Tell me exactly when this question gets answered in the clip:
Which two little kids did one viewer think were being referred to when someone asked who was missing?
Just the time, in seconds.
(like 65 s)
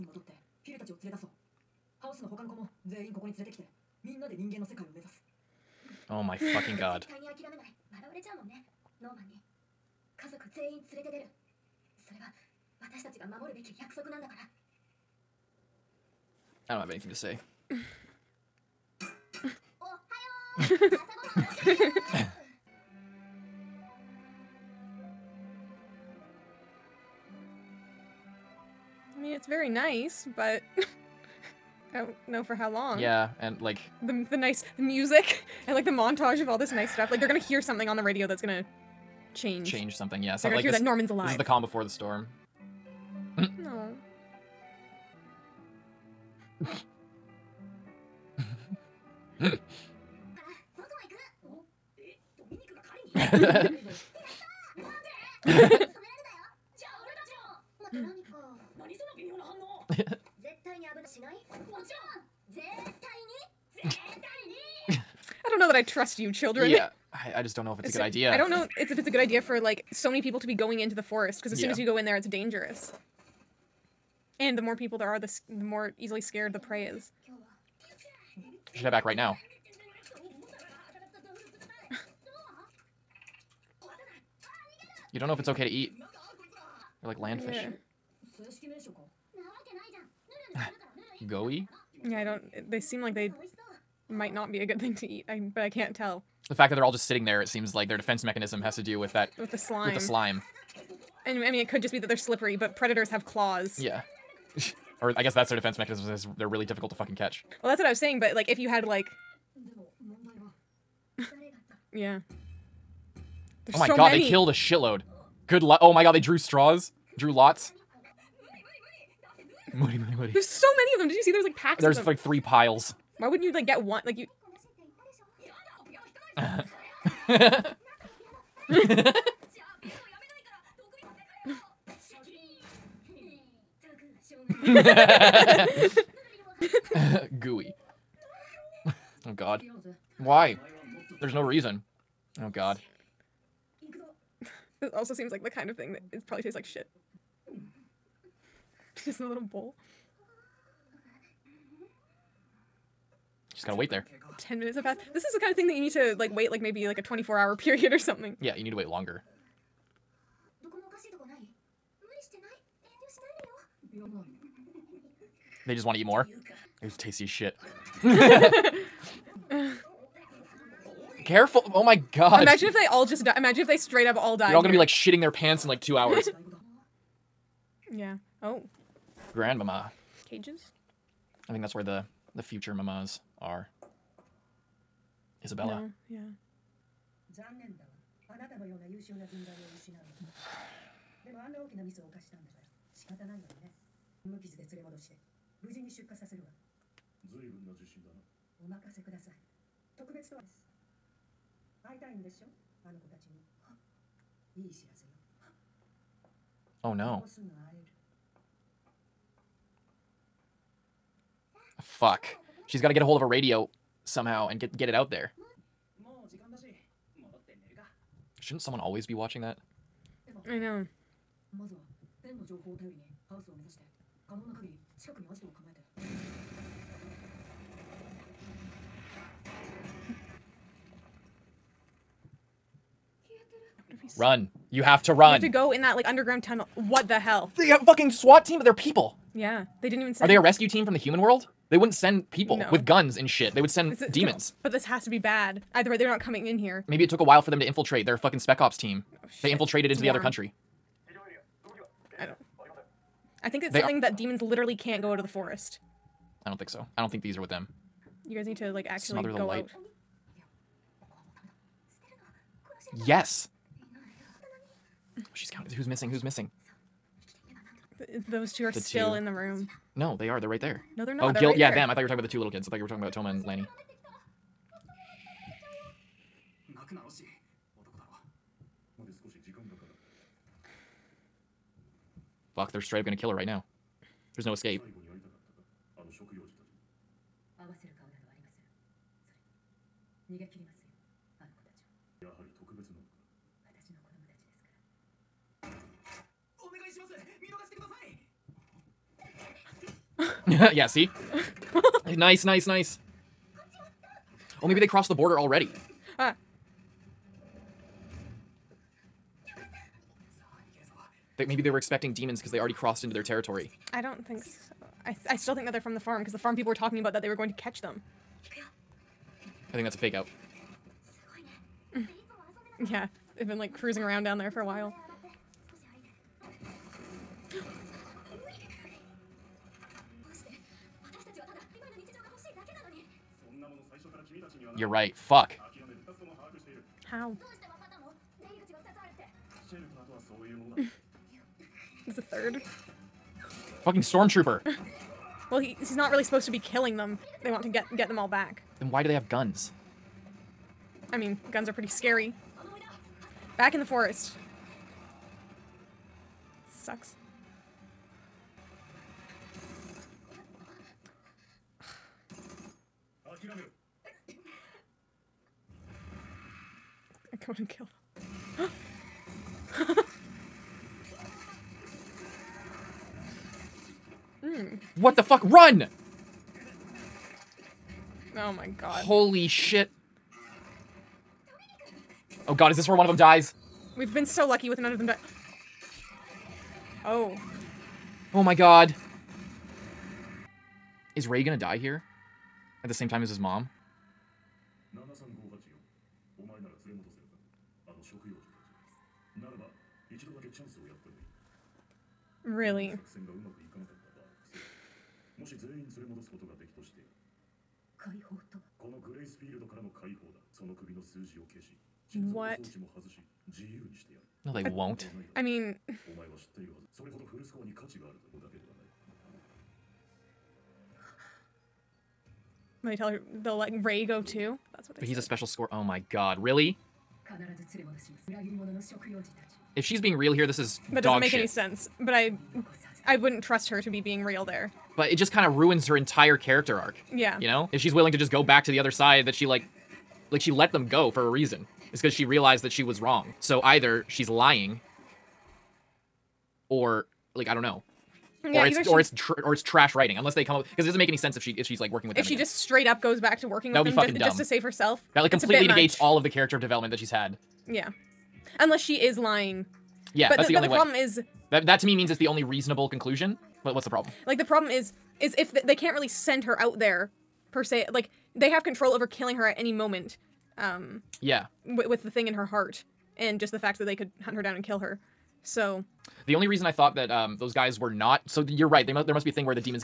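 273 s.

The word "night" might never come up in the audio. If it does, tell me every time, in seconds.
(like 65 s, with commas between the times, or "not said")
not said.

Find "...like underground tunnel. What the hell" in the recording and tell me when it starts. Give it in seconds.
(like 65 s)
235 s.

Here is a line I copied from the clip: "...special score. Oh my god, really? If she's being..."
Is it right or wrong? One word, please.
right.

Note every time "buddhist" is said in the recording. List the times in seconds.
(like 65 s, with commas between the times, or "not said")
not said.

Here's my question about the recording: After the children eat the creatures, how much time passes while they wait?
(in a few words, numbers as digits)
10 minutes.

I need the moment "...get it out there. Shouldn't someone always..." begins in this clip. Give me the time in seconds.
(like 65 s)
214 s.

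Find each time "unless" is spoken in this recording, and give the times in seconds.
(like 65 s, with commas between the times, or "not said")
450 s, 458 s.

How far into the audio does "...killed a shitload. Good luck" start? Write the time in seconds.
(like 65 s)
114 s.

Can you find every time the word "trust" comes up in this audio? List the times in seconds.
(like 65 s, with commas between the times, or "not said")
65 s, 433 s.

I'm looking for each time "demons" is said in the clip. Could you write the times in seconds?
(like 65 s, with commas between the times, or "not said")
244 s, 254 s, 312 s.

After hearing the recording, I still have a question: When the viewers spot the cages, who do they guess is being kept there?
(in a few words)
The future mamas.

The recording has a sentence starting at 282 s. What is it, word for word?
Fuck, they're straight up gonna kill her right now.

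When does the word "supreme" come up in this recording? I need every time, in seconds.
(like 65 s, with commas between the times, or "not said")
not said.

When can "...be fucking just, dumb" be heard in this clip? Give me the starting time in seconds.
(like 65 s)
453 s.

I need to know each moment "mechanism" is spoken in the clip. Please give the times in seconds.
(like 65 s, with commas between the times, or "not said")
98 s, 105 s.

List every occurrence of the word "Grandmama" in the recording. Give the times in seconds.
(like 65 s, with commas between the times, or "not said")
179 s.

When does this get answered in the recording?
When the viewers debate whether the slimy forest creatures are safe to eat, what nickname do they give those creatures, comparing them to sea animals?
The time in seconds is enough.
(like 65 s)
87 s.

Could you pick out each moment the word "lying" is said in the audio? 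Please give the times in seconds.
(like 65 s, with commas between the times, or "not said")
444 s, 459 s.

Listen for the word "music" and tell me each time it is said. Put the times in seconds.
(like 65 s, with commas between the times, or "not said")
34 s.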